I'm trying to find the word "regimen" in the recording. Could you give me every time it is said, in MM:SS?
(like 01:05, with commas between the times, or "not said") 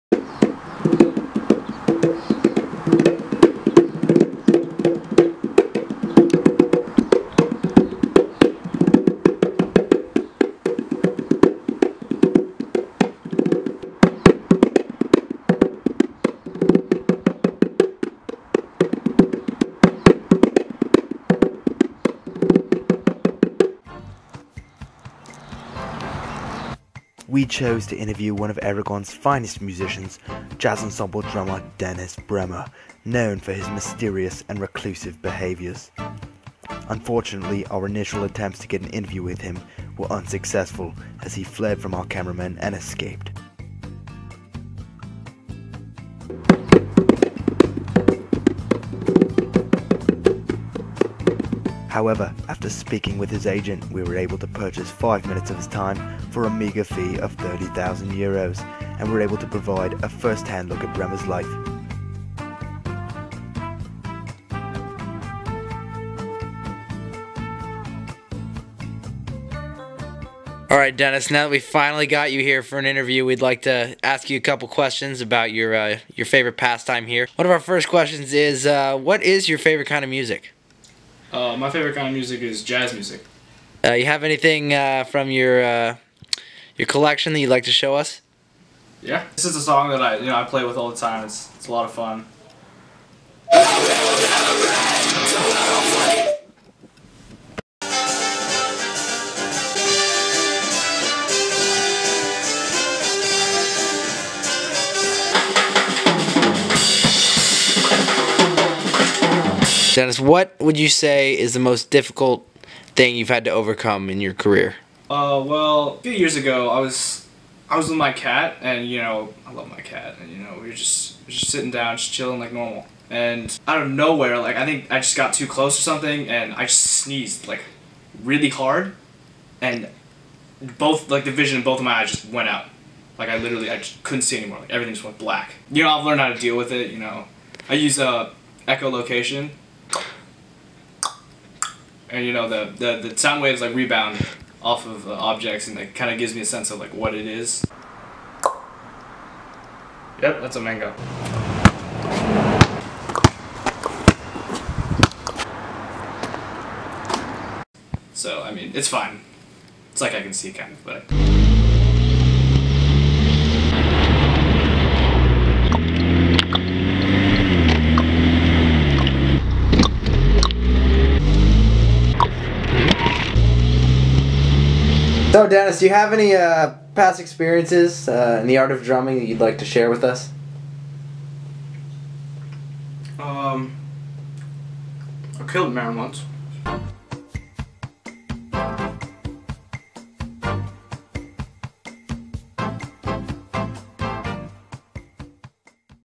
not said.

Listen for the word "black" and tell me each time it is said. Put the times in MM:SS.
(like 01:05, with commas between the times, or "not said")
02:15.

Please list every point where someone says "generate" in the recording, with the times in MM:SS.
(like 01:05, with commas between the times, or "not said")
not said.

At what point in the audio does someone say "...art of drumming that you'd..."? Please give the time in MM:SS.
02:58.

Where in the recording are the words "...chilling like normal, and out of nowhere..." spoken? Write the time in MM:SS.
02:02.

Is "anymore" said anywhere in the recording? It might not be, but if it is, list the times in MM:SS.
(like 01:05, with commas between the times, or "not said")
02:14.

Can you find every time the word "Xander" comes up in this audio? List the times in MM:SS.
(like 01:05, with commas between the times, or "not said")
not said.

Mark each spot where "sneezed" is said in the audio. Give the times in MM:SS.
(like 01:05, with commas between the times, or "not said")
02:06.